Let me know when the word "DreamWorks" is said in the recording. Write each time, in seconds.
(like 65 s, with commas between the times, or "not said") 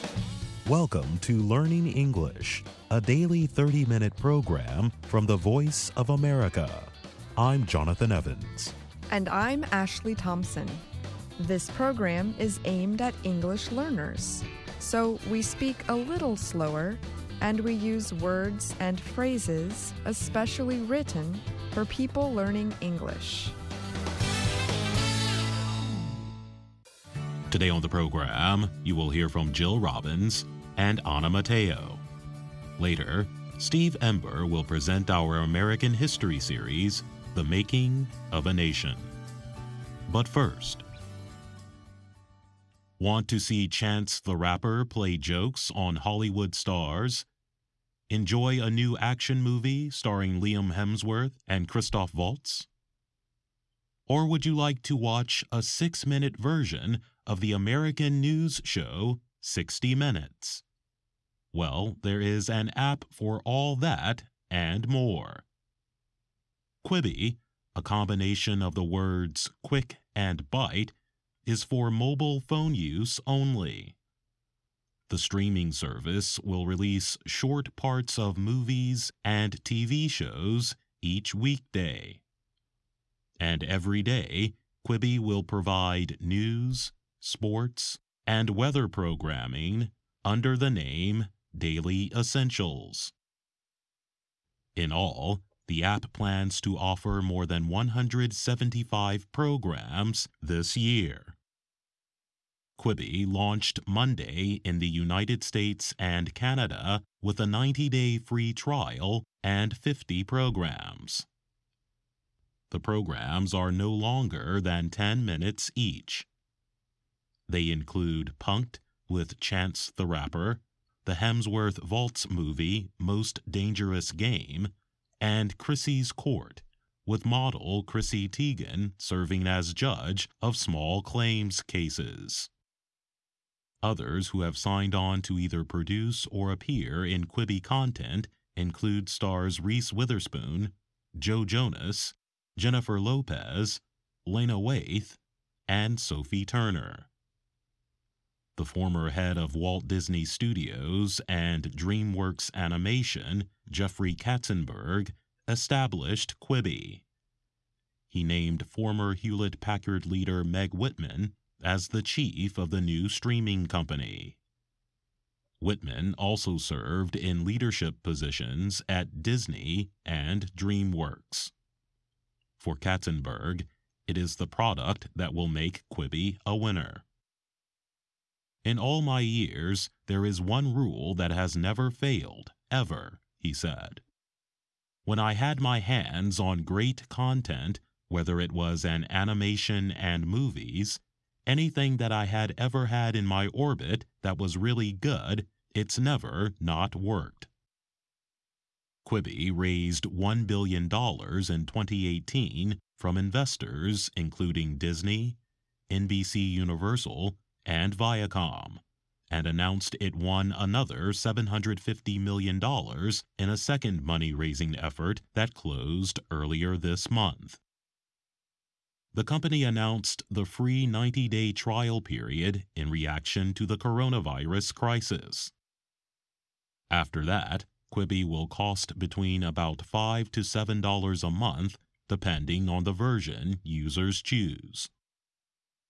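151 s, 170 s.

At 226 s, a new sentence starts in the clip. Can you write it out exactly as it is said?
After that, Quibi will cost between about $5 to $7 a month, depending on the version users choose.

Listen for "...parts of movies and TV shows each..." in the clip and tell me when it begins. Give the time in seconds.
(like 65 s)
77 s.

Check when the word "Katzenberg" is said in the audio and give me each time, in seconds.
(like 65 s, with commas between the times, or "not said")
154 s, 172 s.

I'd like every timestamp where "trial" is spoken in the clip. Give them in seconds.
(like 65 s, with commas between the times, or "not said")
108 s, 221 s.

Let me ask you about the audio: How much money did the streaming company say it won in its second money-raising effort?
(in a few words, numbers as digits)
$750 million.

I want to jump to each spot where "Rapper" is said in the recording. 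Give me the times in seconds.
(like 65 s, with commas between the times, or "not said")
44 s, 120 s.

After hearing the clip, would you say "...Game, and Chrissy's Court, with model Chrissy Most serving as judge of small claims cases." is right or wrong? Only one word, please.
wrong.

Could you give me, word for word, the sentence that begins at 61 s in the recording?
Well, there is an app for all that and more.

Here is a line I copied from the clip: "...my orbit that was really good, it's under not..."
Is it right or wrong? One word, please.
wrong.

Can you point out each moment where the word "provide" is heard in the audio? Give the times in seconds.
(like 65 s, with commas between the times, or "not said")
85 s.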